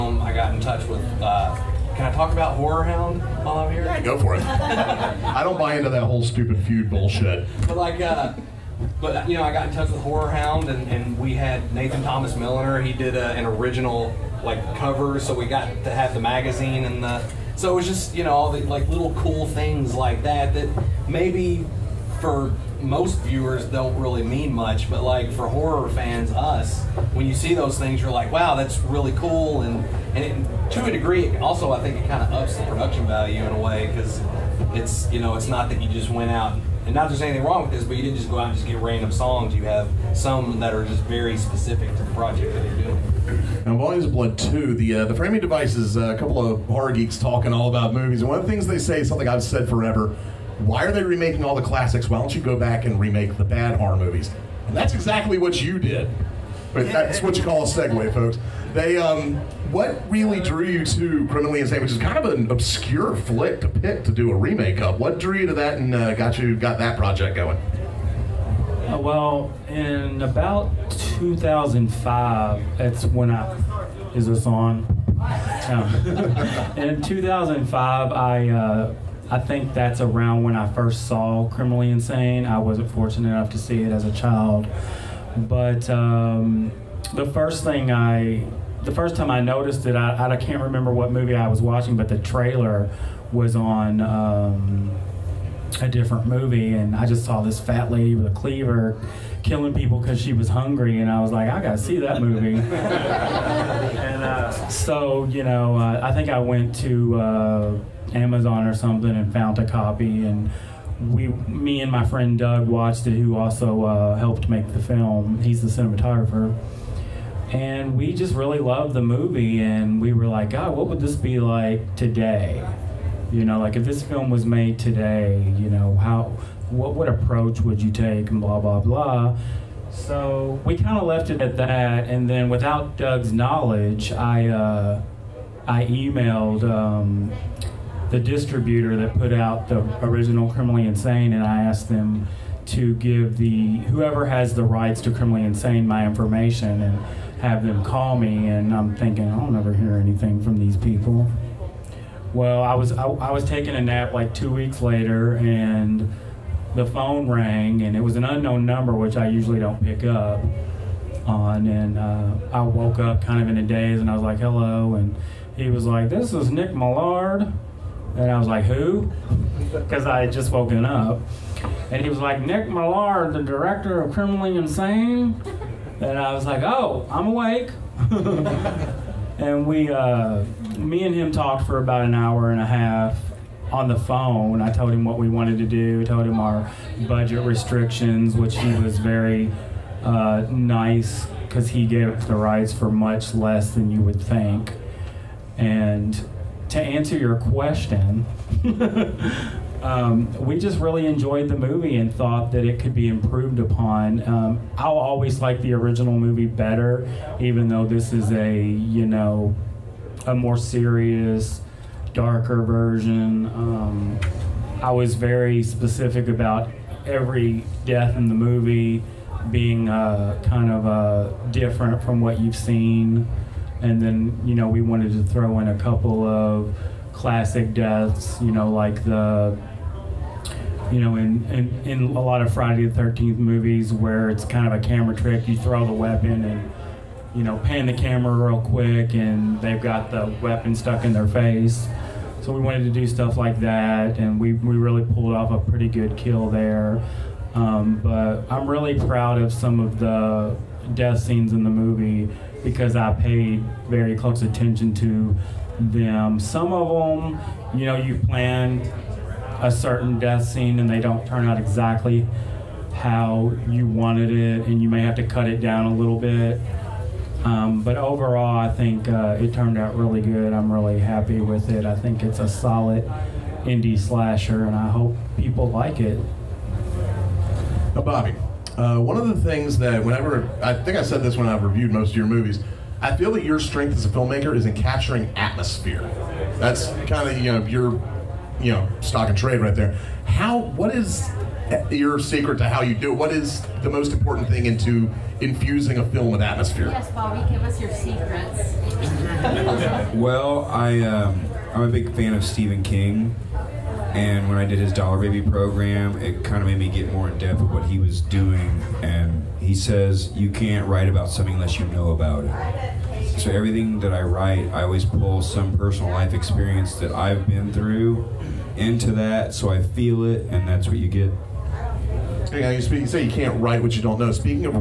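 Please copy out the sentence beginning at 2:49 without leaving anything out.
Because I had just woken up.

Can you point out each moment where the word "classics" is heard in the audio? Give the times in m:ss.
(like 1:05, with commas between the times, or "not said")
0:51, 3:47.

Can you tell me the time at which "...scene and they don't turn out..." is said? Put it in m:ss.
4:20.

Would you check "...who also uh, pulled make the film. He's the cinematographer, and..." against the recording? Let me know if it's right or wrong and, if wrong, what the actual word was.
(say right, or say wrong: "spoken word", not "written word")
wrong: "helped", not "pulled".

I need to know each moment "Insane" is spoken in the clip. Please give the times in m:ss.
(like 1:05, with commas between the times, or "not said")
1:01, 1:21, 2:20, 2:25, 2:54.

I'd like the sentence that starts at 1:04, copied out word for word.
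What drew you to that and uh, got you got that project going?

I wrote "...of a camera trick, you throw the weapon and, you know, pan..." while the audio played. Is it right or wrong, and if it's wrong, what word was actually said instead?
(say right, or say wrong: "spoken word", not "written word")
right.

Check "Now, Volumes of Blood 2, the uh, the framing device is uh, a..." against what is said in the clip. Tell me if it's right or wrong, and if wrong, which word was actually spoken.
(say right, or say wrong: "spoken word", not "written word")
right.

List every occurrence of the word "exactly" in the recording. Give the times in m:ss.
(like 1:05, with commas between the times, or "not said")
0:54, 4:21.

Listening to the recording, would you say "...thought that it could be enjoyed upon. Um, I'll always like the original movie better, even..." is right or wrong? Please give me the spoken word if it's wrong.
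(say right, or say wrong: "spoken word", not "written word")
wrong: "improved", not "enjoyed".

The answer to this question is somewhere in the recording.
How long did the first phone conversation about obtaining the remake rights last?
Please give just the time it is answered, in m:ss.
3:02.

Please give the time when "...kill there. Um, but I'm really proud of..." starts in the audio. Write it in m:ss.
4:06.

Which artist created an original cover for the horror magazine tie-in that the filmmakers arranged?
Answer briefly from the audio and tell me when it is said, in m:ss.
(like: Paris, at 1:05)
Nathan Thomas Milliner, at 0:11.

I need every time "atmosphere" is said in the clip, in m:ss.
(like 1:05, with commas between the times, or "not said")
4:45, 4:56.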